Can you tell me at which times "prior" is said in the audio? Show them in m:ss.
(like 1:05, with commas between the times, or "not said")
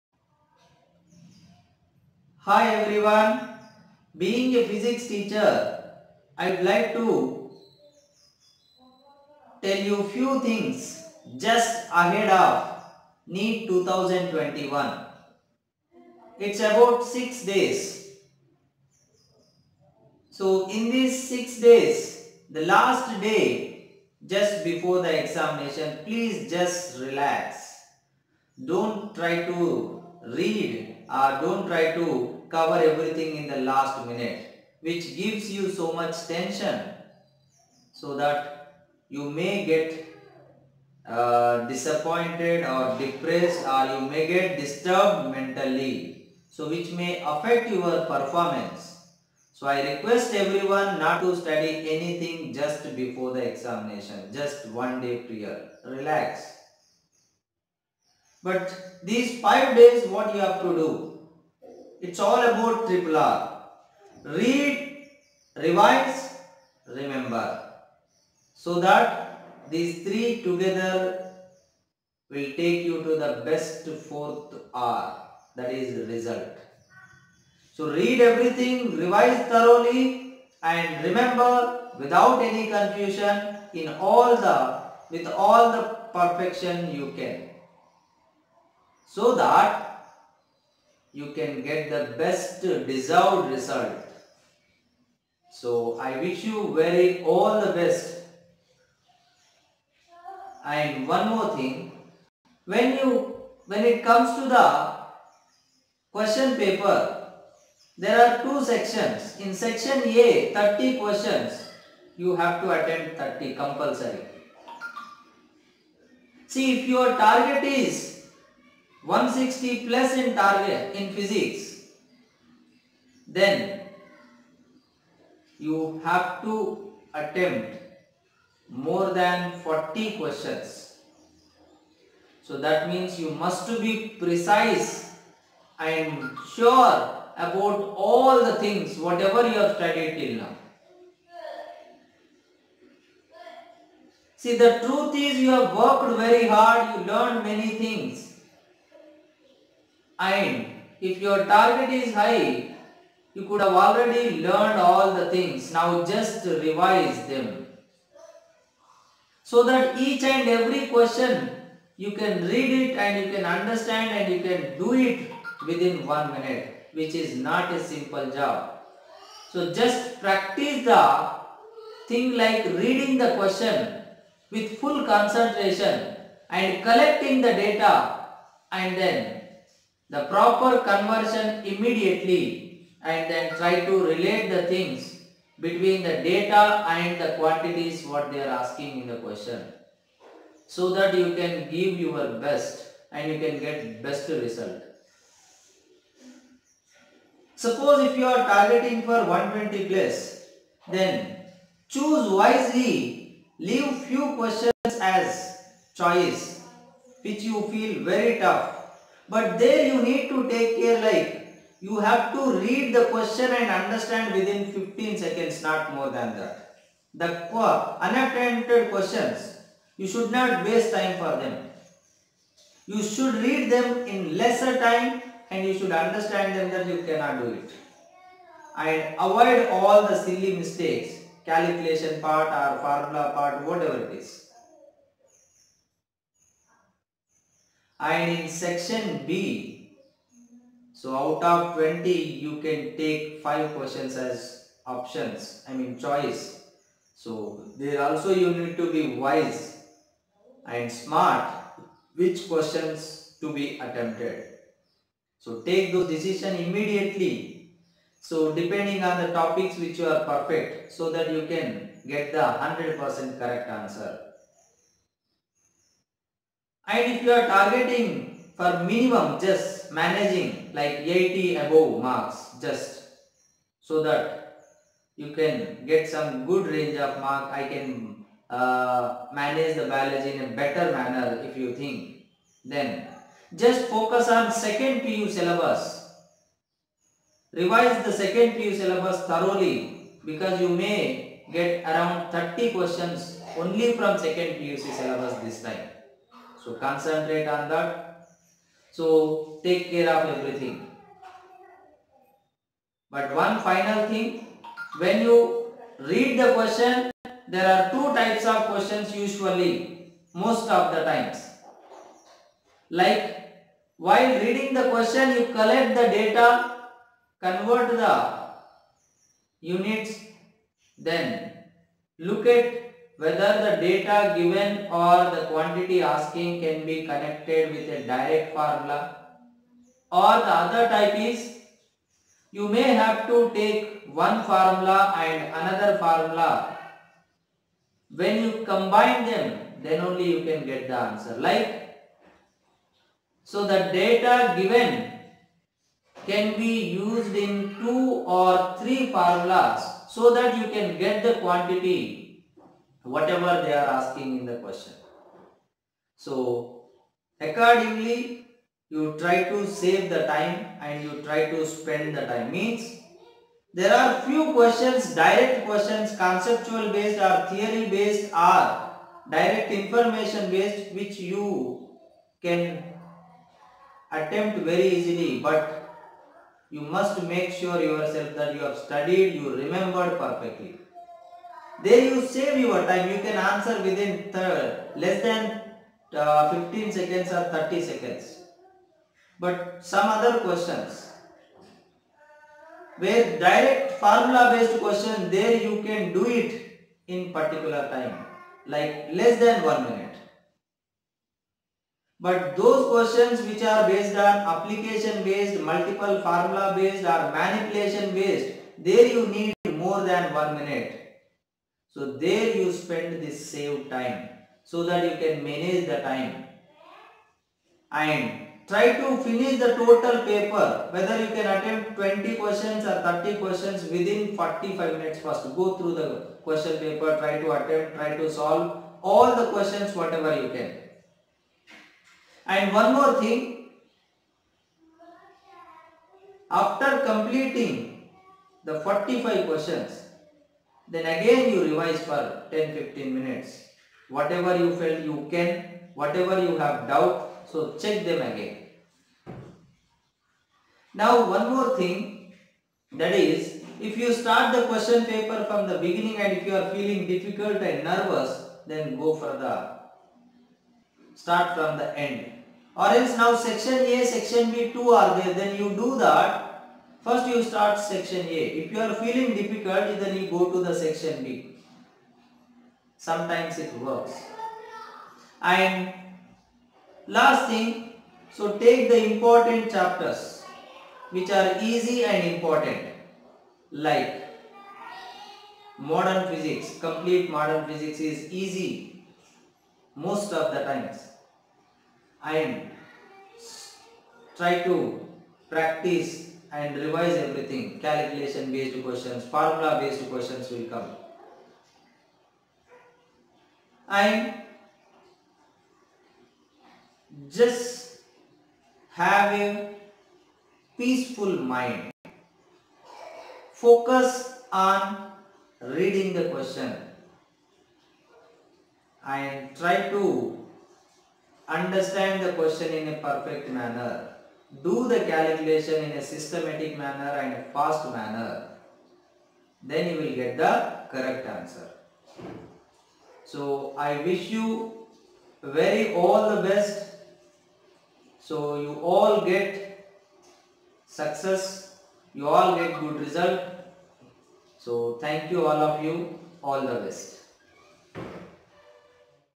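0:55.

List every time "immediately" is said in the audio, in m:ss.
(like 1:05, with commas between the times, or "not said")
3:01, 4:16.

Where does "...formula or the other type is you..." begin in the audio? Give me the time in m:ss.
5:28.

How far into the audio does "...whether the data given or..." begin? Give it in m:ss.
5:23.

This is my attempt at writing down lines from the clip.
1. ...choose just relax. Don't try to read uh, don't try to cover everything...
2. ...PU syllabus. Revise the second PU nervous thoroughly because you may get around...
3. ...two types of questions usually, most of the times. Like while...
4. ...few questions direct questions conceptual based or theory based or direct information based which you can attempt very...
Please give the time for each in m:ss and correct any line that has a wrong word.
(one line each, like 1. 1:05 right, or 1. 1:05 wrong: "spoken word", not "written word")
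1. 0:26 wrong: "please", not "choose"
2. 4:45 wrong: "syllabus", not "nervous"
3. 5:07 right
4. 6:04 right.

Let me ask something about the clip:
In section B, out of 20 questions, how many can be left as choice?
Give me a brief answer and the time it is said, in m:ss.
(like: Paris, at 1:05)
5, at 4:03.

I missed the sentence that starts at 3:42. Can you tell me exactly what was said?
You should read them in lesser time and you should understand them that you cannot do it.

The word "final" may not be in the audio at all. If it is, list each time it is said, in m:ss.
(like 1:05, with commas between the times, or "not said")
5:03.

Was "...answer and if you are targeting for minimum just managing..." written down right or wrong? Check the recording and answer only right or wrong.
right.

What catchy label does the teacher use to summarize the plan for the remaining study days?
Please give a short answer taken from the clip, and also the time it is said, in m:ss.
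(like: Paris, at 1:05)
Triple R, at 1:02.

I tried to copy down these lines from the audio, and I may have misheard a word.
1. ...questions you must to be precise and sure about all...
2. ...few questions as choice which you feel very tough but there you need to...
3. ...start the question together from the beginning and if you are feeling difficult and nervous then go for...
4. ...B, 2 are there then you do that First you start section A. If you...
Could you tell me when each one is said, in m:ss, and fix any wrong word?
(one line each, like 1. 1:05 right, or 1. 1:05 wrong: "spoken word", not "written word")
1. 2:12 wrong: "means", not "questions"
2. 3:24 right
3. 7:34 wrong: "paper", not "together"
4. 7:44 right.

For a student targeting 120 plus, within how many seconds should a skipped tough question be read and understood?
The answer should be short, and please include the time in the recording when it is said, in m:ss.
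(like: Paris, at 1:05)
15 seconds, at 3:34.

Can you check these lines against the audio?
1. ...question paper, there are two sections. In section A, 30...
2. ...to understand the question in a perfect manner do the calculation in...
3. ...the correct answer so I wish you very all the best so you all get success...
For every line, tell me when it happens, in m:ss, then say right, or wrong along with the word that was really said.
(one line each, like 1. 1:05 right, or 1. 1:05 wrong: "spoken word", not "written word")
1. 1:46 right
2. 8:39 right
3. 8:50 right.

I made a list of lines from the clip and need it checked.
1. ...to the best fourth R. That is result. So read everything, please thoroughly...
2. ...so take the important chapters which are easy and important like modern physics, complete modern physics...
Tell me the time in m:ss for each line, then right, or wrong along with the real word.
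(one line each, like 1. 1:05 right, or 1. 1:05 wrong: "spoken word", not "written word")
1. 1:13 wrong: "revise", not "please"
2. 7:58 right.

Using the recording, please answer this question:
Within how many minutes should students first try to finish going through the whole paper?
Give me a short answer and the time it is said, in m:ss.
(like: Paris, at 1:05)
45 minutes, at 7:04.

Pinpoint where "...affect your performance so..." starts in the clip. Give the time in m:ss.
0:47.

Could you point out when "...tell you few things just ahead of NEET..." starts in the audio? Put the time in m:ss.
0:09.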